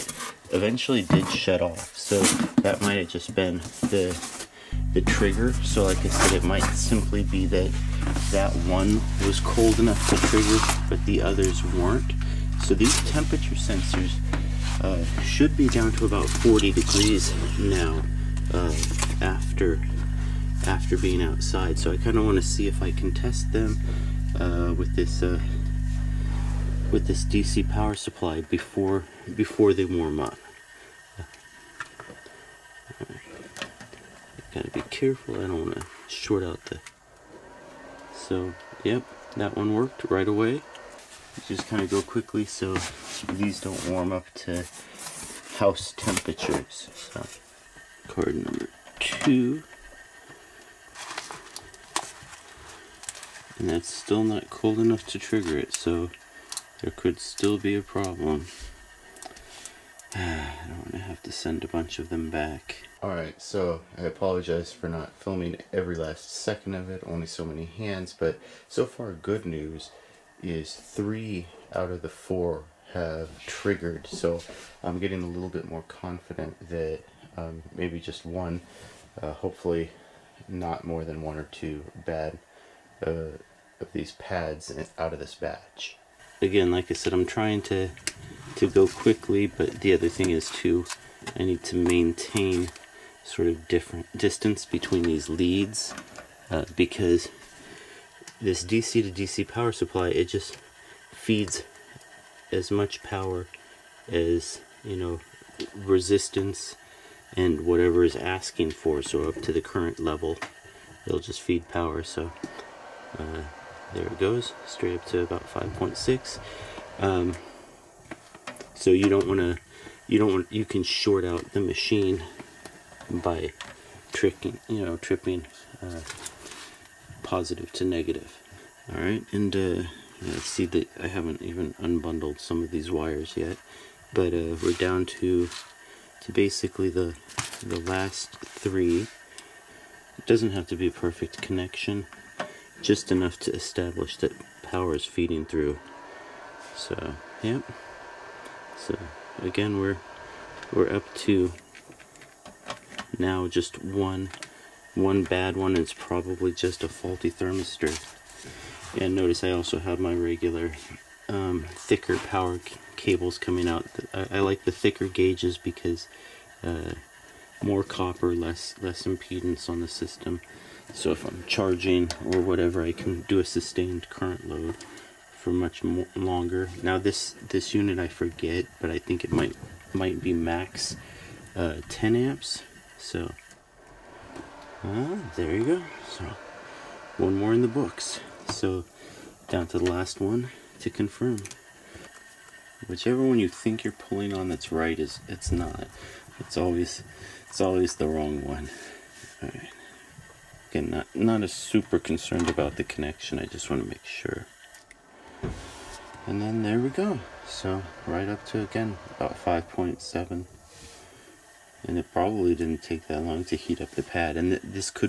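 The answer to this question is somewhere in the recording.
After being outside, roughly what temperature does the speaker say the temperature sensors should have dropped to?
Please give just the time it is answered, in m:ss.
0:16.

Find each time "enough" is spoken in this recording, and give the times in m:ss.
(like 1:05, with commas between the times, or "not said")
0:09, 0:54, 2:23.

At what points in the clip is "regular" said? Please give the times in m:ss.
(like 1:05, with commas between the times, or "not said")
2:40.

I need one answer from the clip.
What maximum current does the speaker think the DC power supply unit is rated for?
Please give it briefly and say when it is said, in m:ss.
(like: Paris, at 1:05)
10 amps, at 3:01.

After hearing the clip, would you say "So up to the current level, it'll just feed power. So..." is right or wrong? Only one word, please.
right.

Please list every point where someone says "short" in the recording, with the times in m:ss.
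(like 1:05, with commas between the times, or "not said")
0:36, 2:00.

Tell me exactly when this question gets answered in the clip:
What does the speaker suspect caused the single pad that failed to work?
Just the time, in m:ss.
2:36.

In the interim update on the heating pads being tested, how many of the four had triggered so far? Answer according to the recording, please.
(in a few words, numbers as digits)
3.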